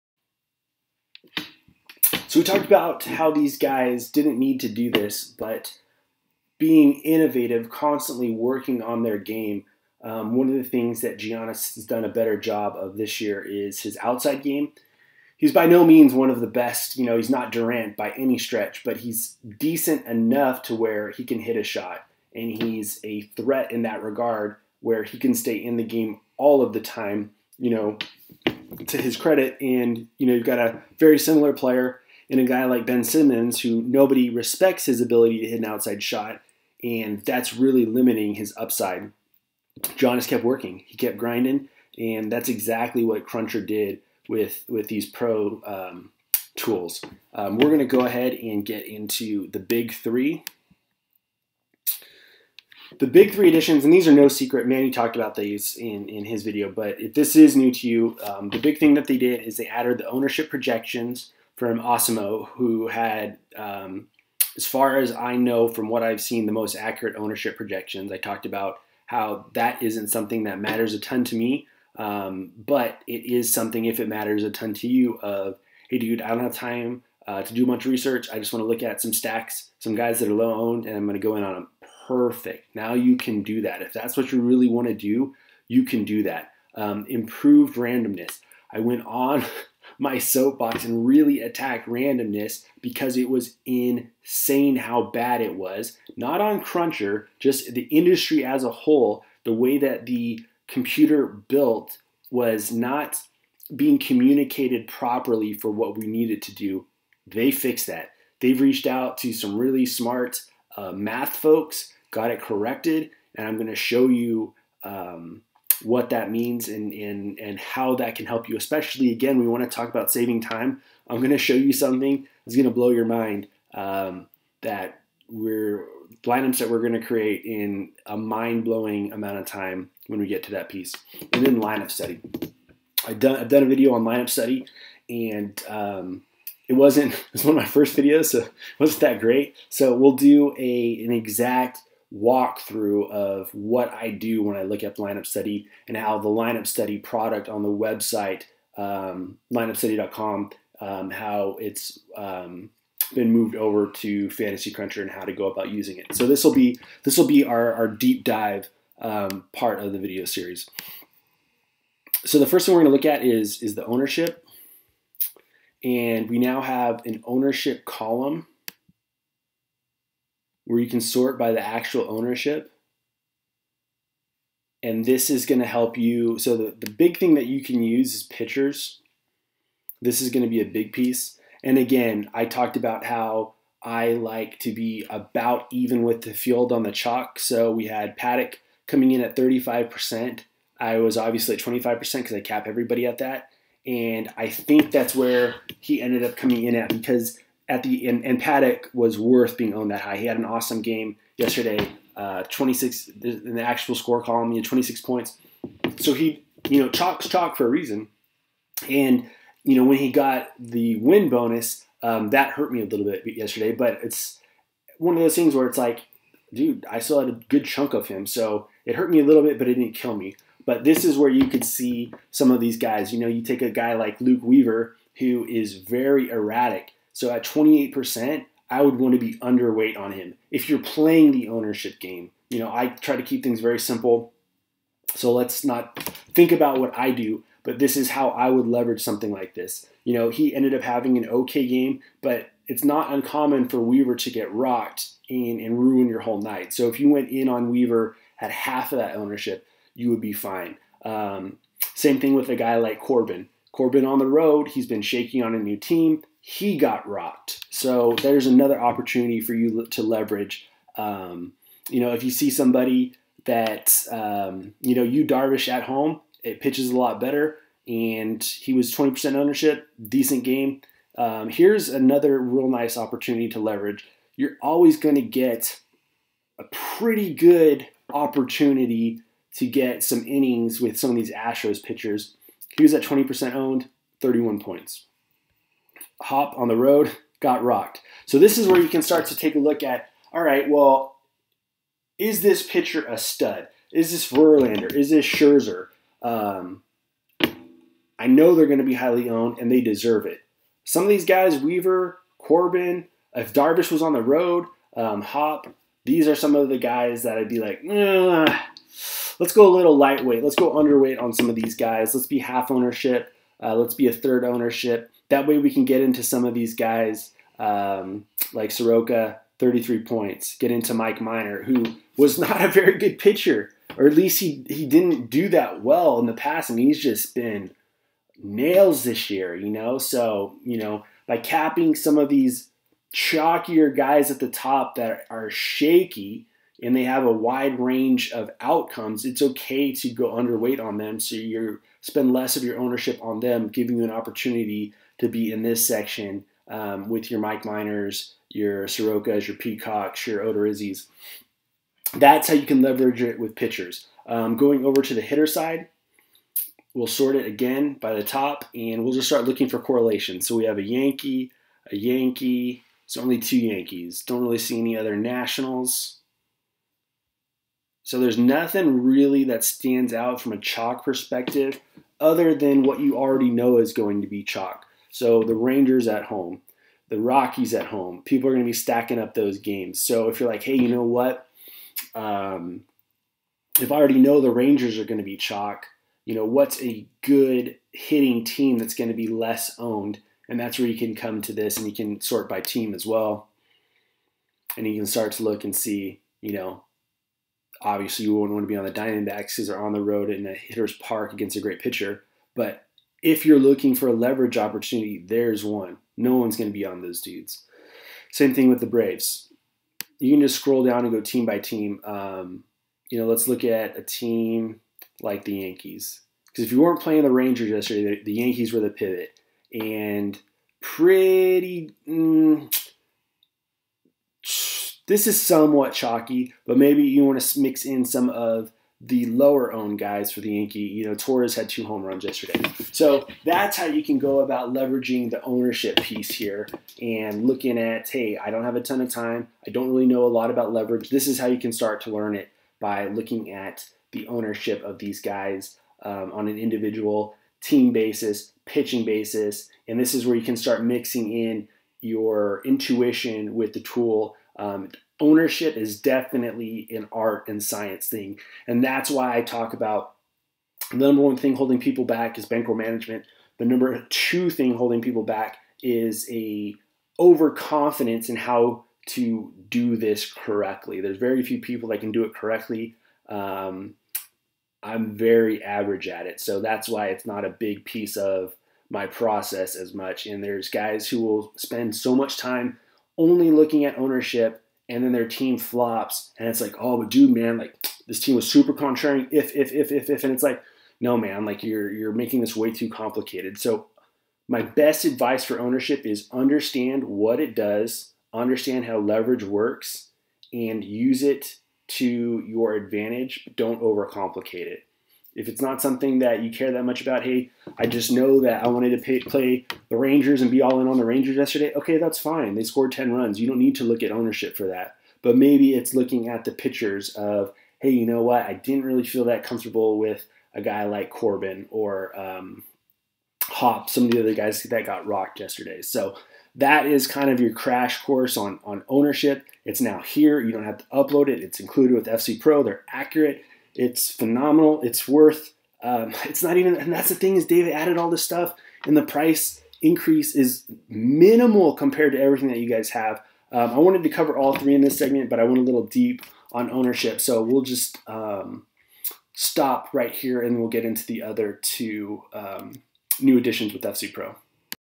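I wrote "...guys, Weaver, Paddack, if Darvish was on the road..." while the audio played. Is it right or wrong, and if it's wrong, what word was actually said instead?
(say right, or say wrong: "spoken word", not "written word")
wrong: "Corbin", not "Paddack".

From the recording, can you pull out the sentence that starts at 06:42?
But if you're looking for a leverage opportunity, there's one.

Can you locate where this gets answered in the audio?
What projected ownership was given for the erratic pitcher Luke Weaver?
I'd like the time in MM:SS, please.
03:47.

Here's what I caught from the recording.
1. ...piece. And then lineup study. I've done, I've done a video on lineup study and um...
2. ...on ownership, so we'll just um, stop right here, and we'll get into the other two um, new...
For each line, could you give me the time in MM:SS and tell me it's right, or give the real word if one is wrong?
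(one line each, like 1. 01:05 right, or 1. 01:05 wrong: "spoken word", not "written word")
1. 02:10 right
2. 09:06 right.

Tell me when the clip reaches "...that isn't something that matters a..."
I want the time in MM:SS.
01:09.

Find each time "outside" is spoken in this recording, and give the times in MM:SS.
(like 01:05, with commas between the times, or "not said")
00:14, 00:35.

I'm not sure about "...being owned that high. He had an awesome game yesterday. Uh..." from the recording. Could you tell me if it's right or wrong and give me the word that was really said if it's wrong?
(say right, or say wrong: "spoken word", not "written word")
right.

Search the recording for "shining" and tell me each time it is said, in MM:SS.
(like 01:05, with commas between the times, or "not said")
not said.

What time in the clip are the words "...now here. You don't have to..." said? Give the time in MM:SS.
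08:49.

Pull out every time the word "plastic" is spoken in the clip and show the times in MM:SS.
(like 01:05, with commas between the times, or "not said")
not said.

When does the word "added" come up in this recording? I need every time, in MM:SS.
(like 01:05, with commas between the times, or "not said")
00:59, 08:57.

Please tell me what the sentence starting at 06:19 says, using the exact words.
So if you're like, hey, you know what?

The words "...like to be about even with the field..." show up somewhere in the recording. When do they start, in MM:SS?
03:04.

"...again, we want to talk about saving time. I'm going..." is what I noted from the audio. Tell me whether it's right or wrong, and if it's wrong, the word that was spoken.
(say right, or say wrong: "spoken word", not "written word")
right.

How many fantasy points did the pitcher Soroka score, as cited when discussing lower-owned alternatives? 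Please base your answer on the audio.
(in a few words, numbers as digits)
33.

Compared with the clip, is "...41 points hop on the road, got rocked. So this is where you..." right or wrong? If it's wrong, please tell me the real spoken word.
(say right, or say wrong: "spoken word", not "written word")
wrong: "31", not "41".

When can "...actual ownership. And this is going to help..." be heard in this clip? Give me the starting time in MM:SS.
02:51.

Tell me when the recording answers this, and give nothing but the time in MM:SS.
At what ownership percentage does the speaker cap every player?
03:11.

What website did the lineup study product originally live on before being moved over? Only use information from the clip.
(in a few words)
lineupstudy.com.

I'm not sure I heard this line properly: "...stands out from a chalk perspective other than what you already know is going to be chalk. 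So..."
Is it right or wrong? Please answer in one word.
right.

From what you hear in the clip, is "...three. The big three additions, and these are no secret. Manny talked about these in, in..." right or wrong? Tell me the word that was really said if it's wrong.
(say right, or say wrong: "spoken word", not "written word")
right.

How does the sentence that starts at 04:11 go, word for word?
Um, same thing with a guy like Corbin.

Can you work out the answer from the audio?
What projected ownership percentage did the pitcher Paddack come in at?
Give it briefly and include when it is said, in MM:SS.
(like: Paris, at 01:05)
35%, at 03:09.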